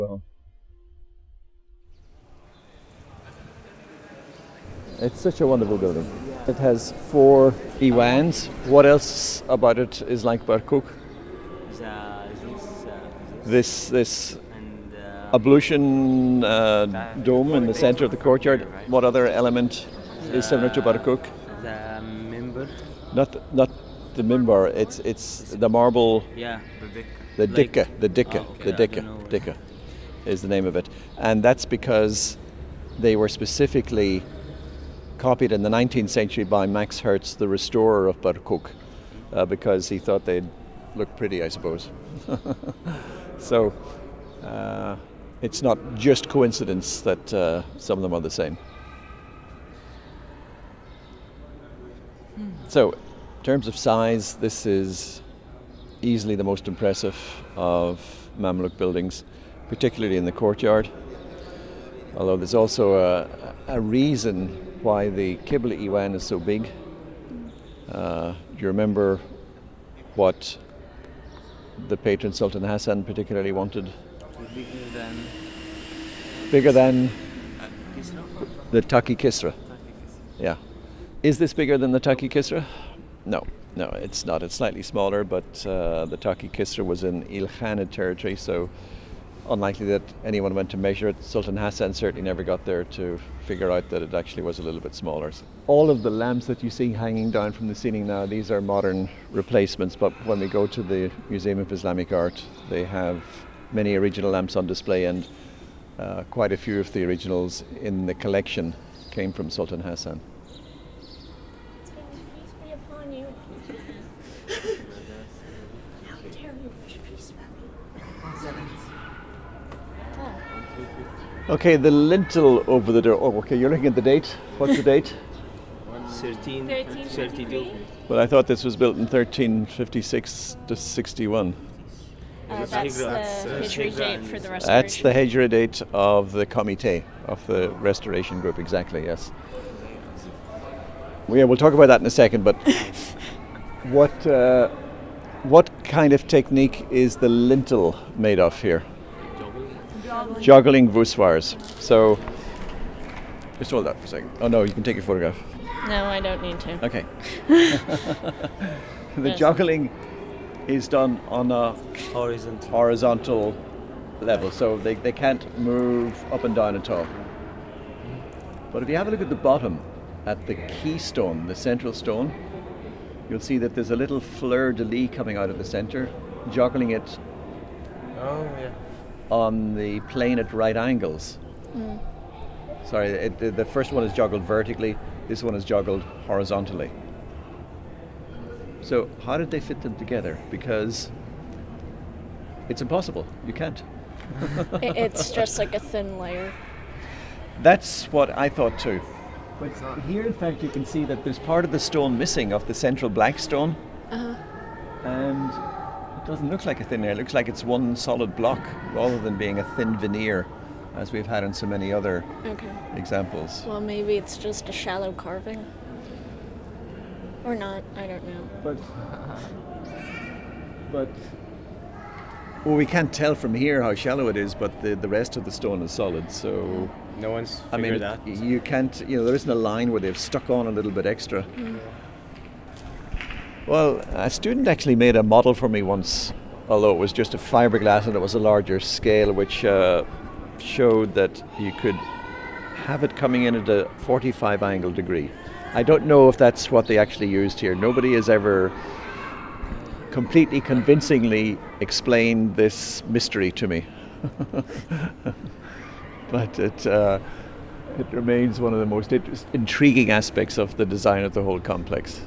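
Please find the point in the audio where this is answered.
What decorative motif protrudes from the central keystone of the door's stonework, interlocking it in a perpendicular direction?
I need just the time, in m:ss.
2:54.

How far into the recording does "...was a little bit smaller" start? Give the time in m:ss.
1:34.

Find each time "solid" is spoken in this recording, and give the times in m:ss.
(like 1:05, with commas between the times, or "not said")
3:27, 3:45.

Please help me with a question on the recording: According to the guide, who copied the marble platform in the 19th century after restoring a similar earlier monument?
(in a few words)
Max Herz.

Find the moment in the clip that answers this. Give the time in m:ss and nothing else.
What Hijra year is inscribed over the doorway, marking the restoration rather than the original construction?
2:06.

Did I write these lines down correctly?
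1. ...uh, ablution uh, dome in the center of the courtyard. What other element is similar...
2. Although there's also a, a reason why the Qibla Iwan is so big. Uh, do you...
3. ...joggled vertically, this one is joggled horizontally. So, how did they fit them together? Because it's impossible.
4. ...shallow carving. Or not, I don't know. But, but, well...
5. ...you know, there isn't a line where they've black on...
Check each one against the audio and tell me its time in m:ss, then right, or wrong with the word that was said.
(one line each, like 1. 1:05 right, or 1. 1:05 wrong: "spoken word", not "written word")
1. 0:14 right
2. 1:02 right
3. 3:04 right
4. 3:34 right
5. 3:49 wrong: "stuck", not "black".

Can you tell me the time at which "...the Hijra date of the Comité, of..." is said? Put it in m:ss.
2:15.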